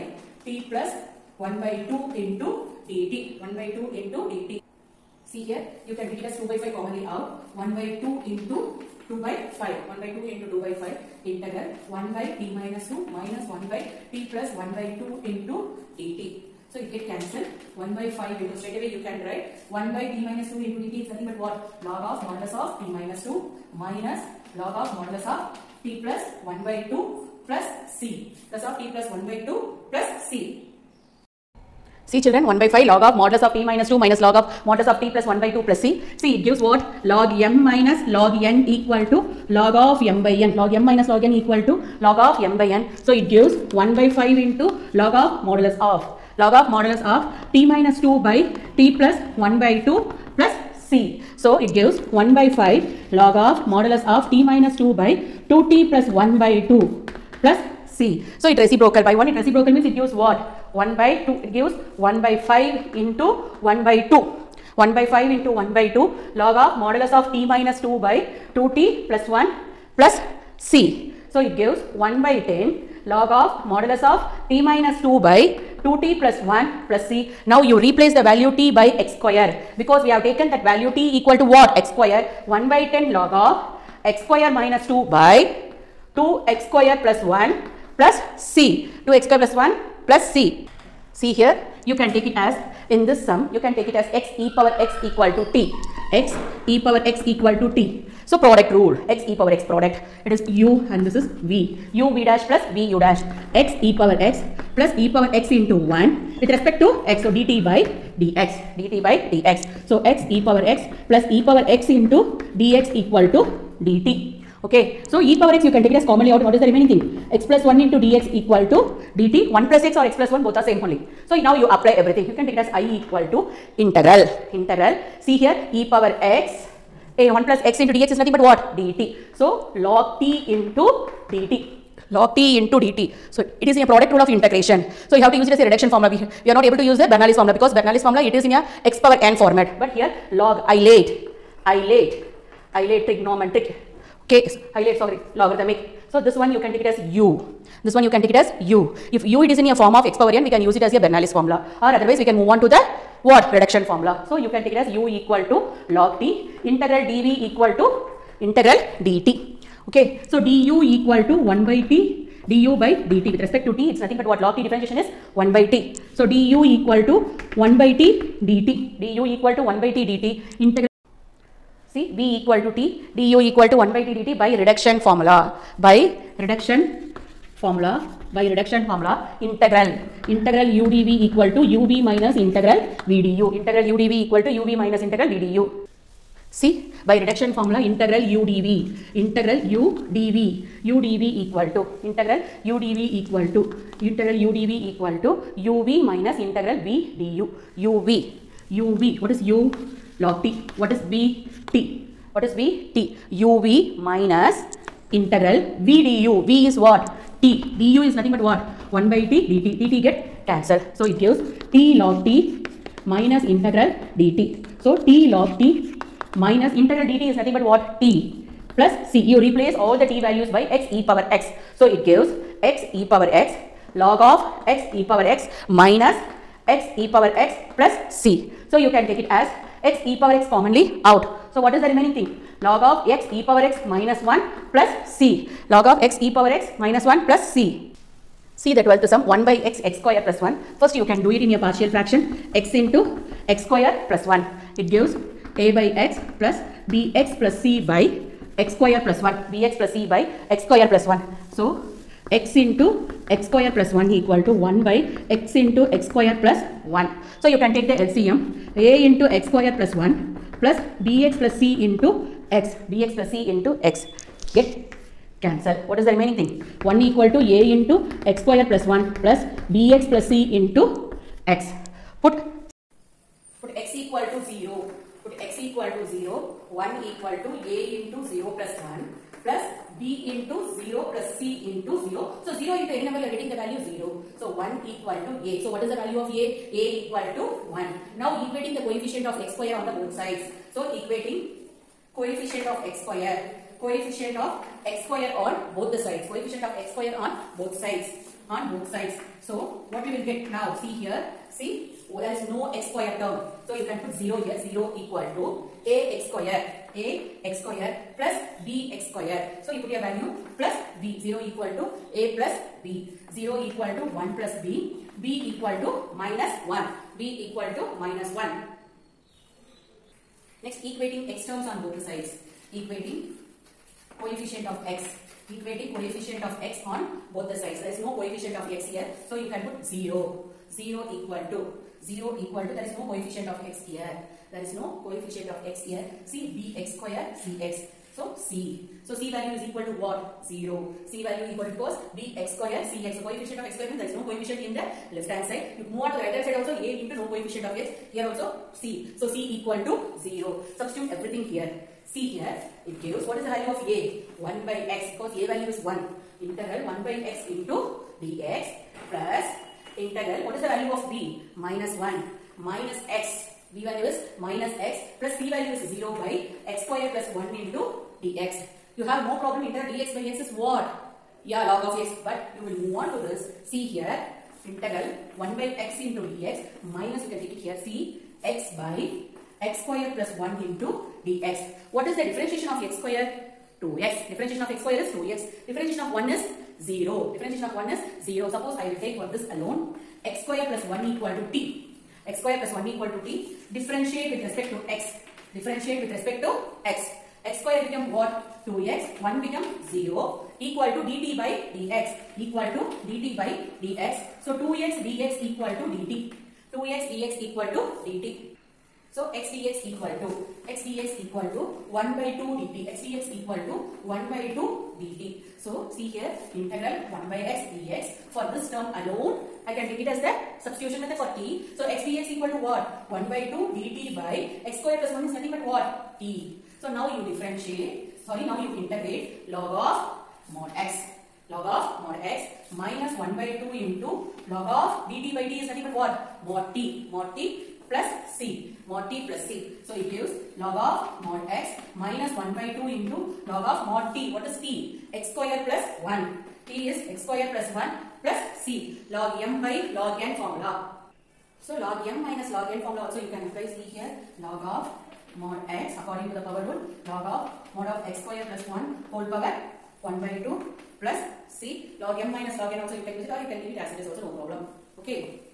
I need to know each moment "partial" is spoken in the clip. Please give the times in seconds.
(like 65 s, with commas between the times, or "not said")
241 s.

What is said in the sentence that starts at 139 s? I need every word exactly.
But here log ilate, ilate, late trigonometric, okay, so, late sorry, logarithmic.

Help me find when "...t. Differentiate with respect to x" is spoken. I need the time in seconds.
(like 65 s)
393 s.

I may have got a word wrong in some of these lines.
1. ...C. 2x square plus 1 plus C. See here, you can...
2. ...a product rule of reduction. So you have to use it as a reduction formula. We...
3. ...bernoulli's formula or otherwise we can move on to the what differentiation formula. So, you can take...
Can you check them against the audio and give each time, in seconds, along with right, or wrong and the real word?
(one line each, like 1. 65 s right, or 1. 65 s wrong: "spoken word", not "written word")
1. 88 s right
2. 133 s wrong: "integration", not "reduction"
3. 151 s wrong: "reduction", not "differentiation".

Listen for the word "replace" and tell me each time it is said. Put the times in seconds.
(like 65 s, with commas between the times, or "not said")
77 s, 219 s, 453 s.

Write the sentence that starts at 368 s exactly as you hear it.
You have no problem integral dx by x is what?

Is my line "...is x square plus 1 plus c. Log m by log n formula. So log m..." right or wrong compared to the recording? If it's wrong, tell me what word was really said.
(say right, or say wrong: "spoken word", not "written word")
right.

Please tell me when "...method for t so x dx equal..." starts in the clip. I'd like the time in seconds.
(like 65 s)
420 s.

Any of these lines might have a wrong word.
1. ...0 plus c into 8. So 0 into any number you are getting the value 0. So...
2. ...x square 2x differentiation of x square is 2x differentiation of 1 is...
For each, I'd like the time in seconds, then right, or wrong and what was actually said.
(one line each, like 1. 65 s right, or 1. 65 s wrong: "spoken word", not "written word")
1. 280 s wrong: "0", not "8"
2. 382 s right.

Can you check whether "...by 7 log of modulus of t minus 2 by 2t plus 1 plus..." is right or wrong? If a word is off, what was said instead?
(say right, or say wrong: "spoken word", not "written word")
wrong: "2", not "7".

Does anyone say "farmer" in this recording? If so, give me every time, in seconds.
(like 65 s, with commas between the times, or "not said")
not said.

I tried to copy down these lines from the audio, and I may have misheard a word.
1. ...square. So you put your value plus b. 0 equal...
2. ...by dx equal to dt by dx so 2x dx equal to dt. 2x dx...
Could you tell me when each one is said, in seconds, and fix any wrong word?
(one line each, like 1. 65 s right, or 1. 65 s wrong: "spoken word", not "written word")
1. 309 s right
2. 401 s right.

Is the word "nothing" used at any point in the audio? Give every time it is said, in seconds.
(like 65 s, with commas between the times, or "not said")
21 s, 128 s, 164 s, 208 s, 217 s, 425 s, 435 s.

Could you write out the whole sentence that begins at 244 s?
It gives a by x plus bx plus c by x square plus 1 bx plus c by x square plus 1.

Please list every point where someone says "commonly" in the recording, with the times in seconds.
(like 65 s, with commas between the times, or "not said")
6 s, 116 s, 230 s.